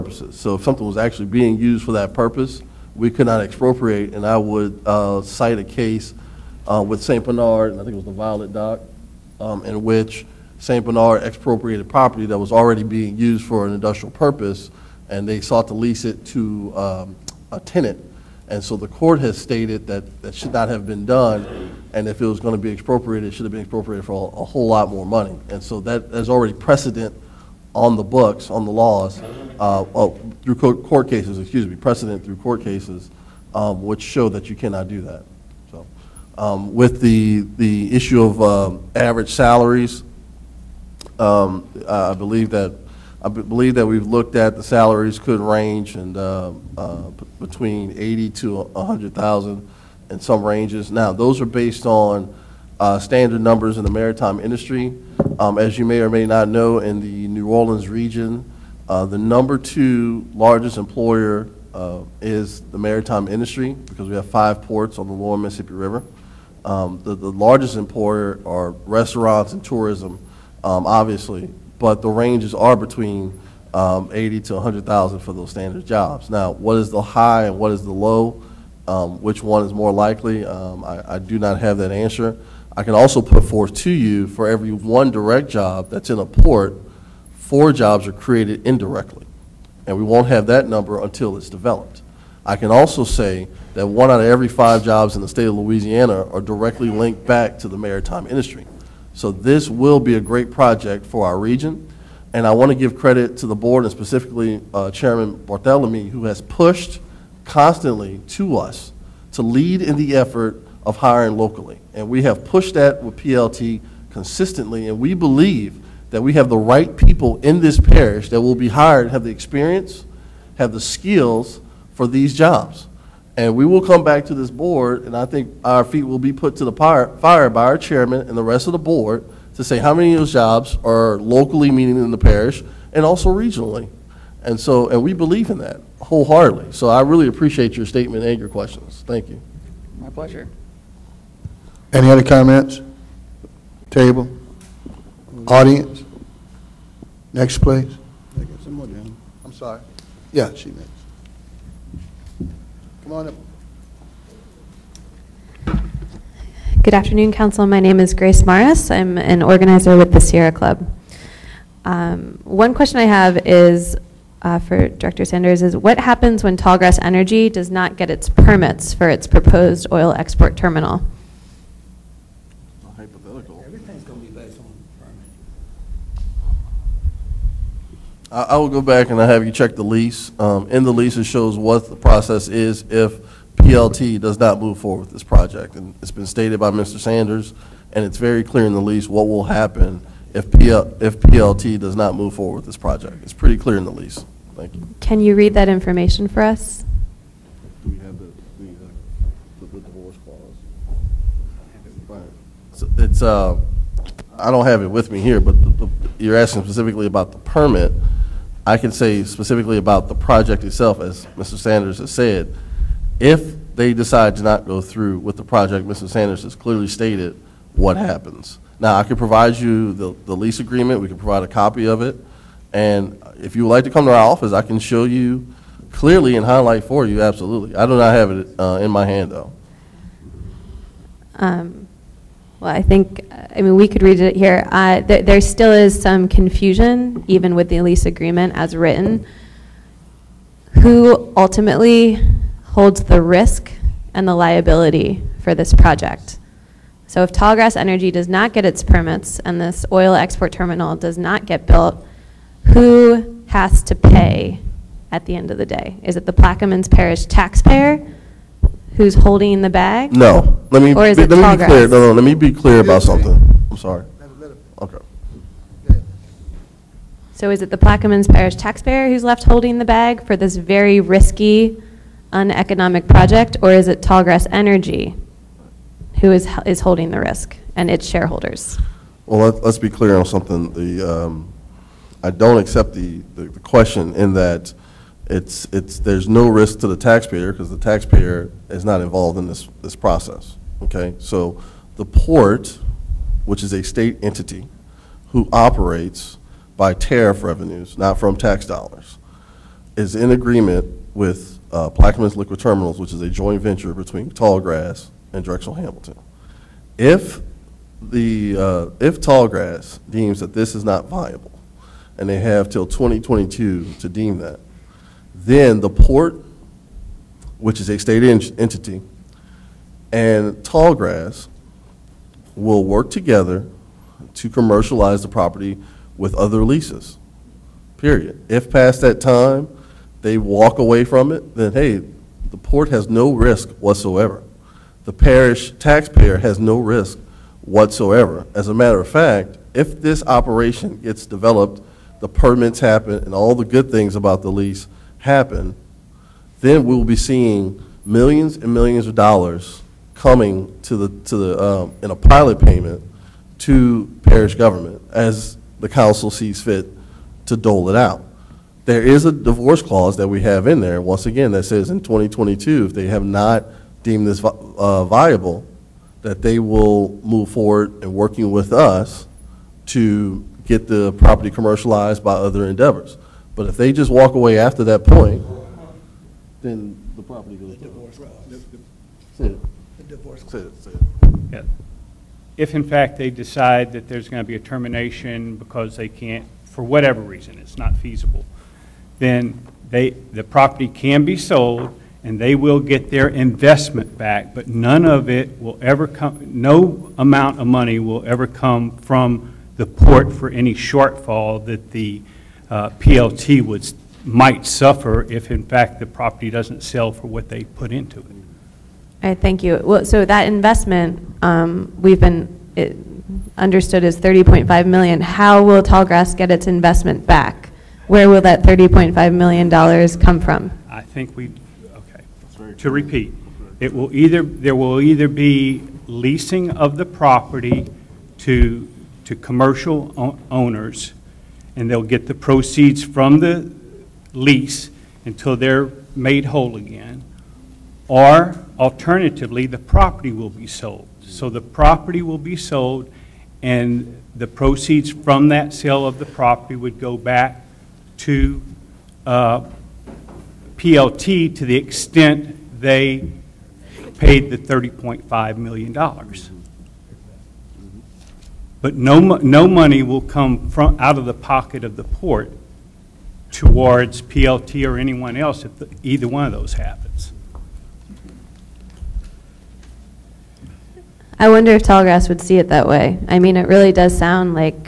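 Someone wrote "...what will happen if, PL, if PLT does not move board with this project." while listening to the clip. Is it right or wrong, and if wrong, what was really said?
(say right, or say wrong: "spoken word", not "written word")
wrong: "forward", not "board".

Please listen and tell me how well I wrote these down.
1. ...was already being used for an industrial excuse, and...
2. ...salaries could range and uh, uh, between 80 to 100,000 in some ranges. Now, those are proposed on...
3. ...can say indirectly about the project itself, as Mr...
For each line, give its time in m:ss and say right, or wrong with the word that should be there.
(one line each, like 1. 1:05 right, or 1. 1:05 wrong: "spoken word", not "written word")
1. 0:12 wrong: "purpose", not "excuse"
2. 0:44 wrong: "based", not "proposed"
3. 3:28 wrong: "specifically", not "indirectly".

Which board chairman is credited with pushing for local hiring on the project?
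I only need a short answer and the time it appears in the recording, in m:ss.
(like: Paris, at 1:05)
Chairman Barthelemy, at 1:44.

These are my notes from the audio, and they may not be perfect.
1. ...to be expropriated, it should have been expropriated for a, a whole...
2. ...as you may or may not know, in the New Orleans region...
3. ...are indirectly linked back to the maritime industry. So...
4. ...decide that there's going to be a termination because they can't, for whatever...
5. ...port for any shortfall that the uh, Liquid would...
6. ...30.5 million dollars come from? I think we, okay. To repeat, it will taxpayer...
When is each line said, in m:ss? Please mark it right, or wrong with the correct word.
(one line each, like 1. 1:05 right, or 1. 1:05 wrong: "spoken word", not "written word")
1. 0:22 right
2. 0:55 right
3. 1:36 wrong: "directly", not "indirectly"
4. 6:23 right
5. 6:39 wrong: "PLT", not "Liquid"
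6. 6:58 wrong: "either", not "taxpayer".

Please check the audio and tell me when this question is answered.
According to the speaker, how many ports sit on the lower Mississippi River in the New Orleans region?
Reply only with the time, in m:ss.
1:04.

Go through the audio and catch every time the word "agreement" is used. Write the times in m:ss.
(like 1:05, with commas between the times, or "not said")
3:40, 3:58, 5:00.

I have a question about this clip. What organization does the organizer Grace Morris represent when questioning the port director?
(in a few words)
Sierra Club.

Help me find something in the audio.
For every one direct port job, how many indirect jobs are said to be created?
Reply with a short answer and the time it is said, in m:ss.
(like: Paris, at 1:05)
4, at 1:27.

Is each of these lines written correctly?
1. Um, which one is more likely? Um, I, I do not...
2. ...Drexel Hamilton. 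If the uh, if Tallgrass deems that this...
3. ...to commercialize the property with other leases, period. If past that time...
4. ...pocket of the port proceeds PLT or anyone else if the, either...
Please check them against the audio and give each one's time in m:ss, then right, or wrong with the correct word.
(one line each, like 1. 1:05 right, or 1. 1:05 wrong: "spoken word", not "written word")
1. 1:18 right
2. 5:05 right
3. 5:24 right
4. 7:41 wrong: "towards", not "proceeds".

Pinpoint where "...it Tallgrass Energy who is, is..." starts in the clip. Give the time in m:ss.
4:33.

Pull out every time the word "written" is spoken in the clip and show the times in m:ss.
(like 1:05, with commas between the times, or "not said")
3:58.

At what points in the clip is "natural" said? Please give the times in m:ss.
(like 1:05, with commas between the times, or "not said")
not said.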